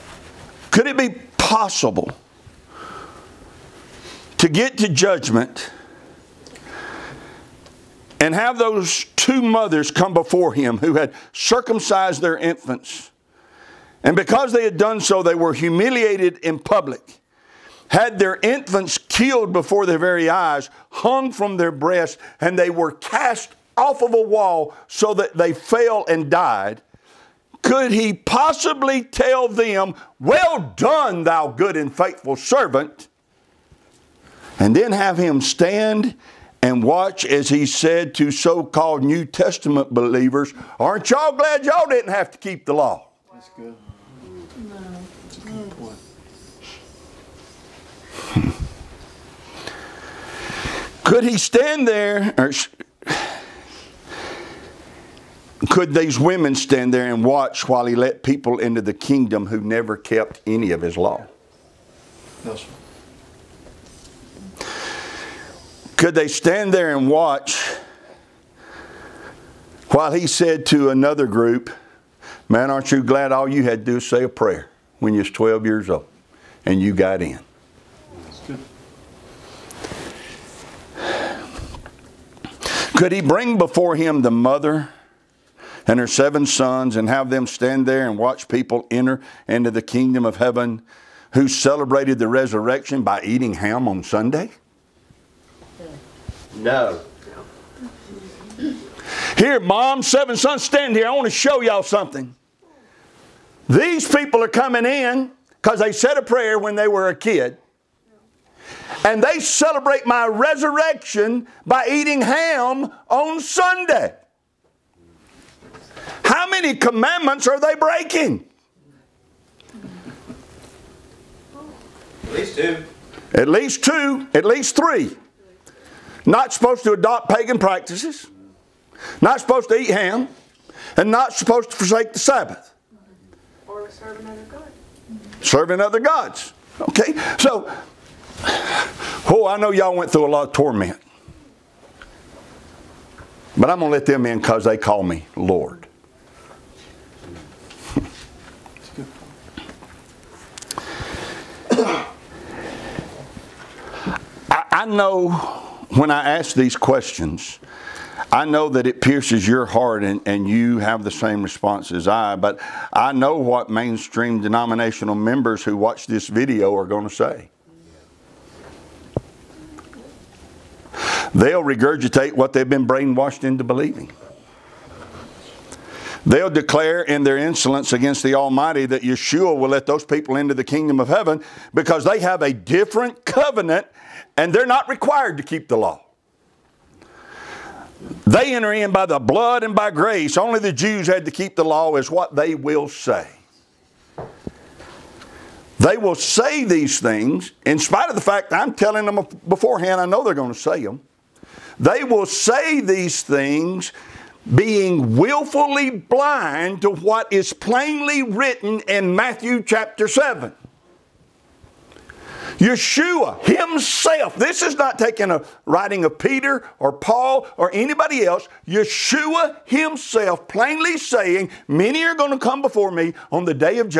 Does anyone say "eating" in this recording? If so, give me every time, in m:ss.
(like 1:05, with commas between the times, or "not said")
1:33, 1:51.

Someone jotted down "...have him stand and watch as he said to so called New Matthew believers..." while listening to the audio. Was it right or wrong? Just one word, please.
wrong.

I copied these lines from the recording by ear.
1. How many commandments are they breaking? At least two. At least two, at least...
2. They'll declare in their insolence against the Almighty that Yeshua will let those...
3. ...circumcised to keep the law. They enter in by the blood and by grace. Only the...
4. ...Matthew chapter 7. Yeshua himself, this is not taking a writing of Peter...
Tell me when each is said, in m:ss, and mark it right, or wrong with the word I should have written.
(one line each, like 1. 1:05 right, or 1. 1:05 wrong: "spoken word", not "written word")
1. 1:56 right
2. 2:56 right
3. 3:04 wrong: "required", not "circumcised"
4. 3:29 right.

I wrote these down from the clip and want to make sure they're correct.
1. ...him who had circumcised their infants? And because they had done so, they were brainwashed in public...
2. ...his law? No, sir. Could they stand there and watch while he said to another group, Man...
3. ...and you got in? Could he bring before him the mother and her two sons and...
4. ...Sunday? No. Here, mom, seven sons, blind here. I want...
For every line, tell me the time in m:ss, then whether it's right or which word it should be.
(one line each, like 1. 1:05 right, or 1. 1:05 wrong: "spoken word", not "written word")
1. 0:10 wrong: "humiliated", not "brainwashed"
2. 1:00 right
3. 1:16 wrong: "seven", not "two"
4. 1:34 wrong: "stand", not "blind".